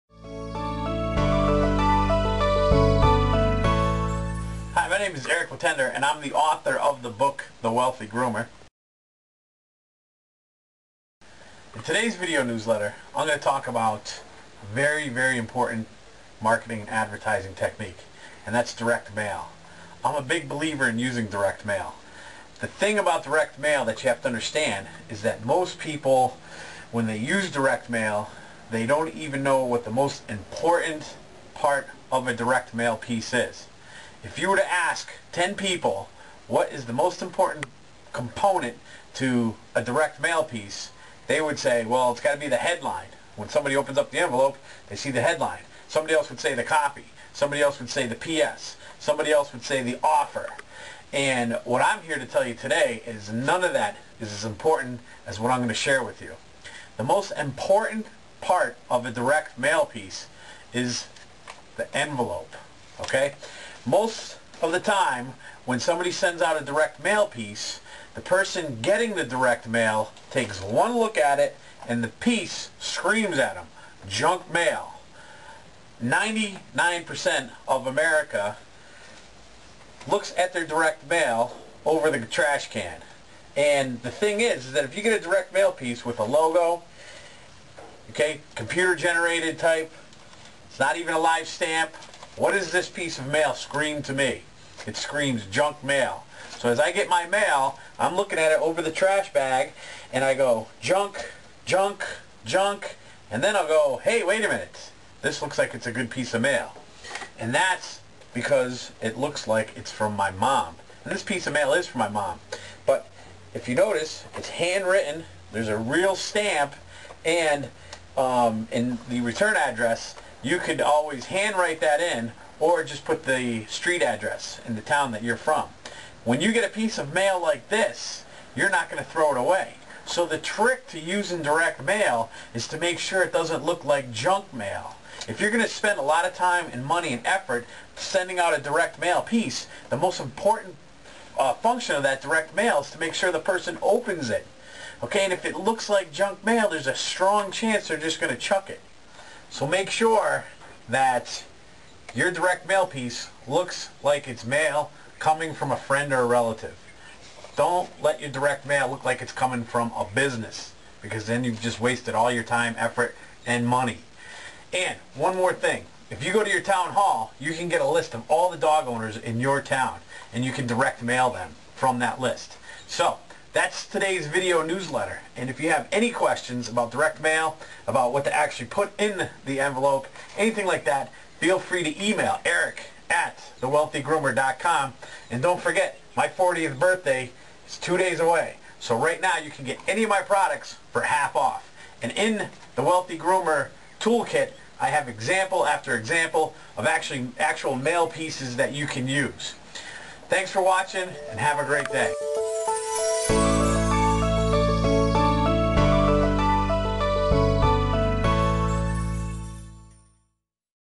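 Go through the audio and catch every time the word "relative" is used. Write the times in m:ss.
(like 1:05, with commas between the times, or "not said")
2:36.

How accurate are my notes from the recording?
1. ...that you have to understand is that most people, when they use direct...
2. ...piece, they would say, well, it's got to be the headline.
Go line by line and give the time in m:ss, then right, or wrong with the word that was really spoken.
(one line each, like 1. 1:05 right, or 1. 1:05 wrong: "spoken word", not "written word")
1. 0:23 right
2. 0:40 right.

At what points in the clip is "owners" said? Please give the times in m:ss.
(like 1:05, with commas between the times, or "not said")
2:48.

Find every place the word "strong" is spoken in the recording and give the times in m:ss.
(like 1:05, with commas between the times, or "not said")
2:26.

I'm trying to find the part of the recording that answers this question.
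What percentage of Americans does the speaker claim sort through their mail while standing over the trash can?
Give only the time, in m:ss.
1:16.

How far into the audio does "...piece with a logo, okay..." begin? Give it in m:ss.
1:25.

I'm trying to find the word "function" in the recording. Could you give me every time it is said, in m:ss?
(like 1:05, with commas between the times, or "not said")
2:21.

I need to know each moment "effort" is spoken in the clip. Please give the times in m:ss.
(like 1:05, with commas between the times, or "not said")
2:17, 2:42.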